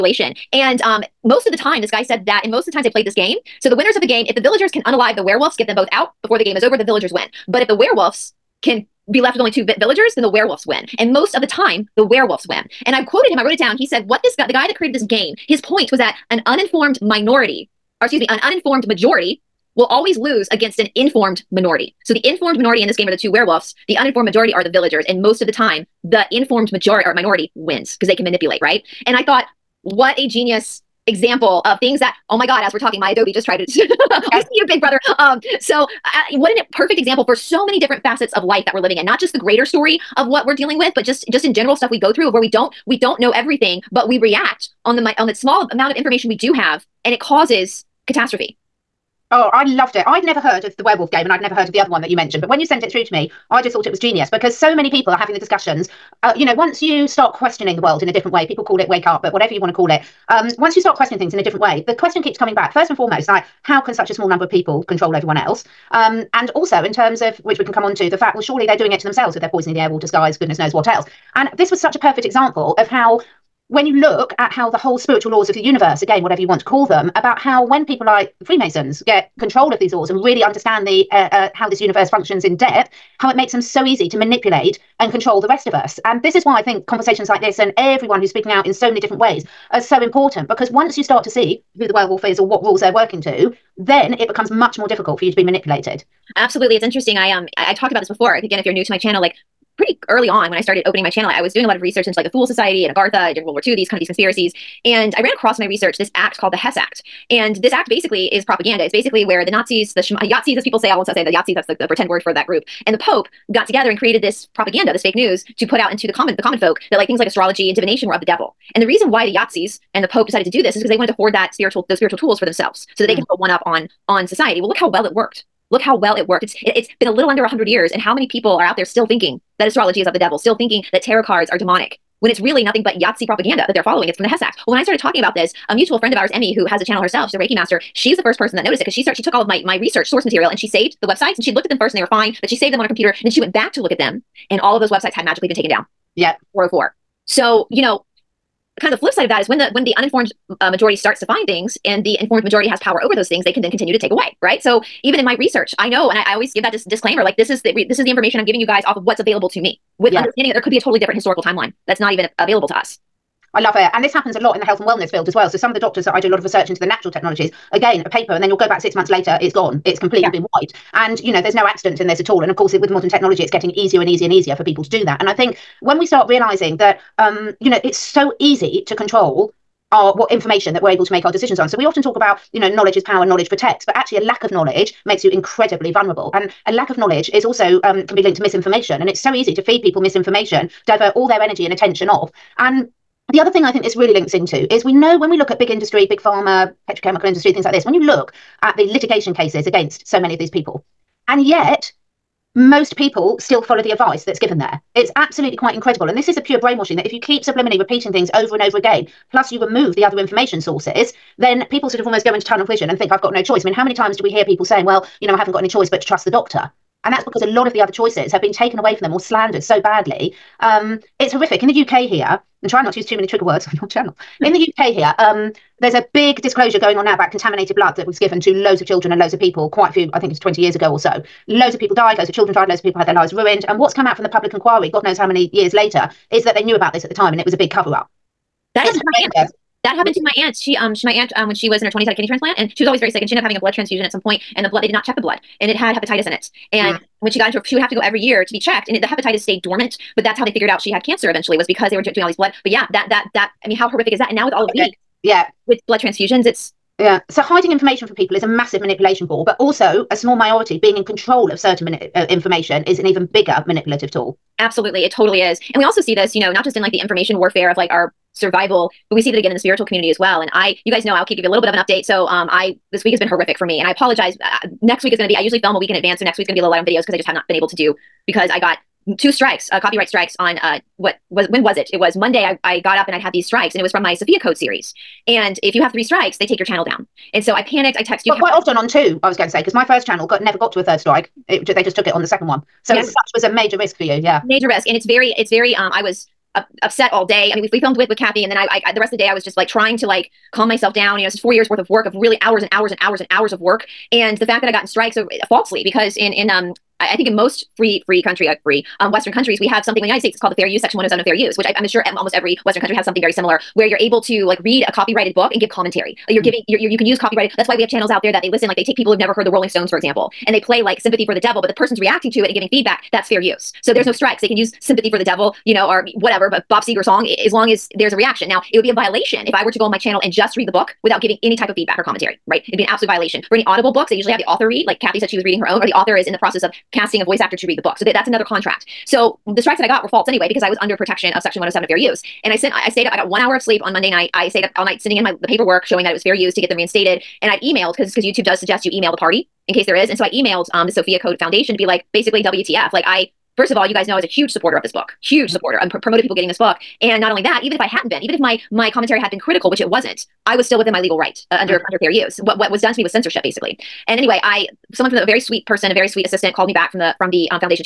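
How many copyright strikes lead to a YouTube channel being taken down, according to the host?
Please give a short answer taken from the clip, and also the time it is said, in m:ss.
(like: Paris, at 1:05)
3, at 4:45.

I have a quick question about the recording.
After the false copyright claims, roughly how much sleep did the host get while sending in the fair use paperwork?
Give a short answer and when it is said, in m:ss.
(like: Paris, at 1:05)
1 hour, at 5:43.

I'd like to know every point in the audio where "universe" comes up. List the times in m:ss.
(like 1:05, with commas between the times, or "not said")
1:15, 1:21.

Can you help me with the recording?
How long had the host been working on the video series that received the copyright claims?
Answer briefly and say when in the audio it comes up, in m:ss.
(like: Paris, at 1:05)
4 years, at 5:01.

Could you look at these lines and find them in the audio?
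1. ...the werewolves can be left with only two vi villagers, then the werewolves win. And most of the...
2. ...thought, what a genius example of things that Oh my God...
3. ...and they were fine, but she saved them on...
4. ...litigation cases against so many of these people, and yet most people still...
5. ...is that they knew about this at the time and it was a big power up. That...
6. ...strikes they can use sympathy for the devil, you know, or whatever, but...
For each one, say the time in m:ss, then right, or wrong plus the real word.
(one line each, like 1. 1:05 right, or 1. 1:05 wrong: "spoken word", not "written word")
1. 0:07 right
2. 0:29 right
3. 2:21 right
4. 3:18 right
5. 3:56 wrong: "cover", not "power"
6. 5:24 right.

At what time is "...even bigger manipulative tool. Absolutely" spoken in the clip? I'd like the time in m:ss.
4:23.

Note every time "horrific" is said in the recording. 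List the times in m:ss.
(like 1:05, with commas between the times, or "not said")
3:41, 4:13, 4:33.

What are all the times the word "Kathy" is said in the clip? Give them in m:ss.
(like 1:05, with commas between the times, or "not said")
4:58, 5:35.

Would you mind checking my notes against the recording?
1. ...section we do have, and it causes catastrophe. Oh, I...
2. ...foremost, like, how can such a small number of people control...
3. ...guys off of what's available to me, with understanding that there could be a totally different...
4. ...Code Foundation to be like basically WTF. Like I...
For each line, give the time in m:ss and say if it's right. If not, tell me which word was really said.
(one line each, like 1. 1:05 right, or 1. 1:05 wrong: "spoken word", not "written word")
1. 0:45 wrong: "information", not "section"
2. 1:02 right
3. 2:38 right
4. 5:51 right.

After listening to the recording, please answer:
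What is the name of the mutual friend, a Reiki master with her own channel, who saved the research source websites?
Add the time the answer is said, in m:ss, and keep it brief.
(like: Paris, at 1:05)
Emmy, at 2:16.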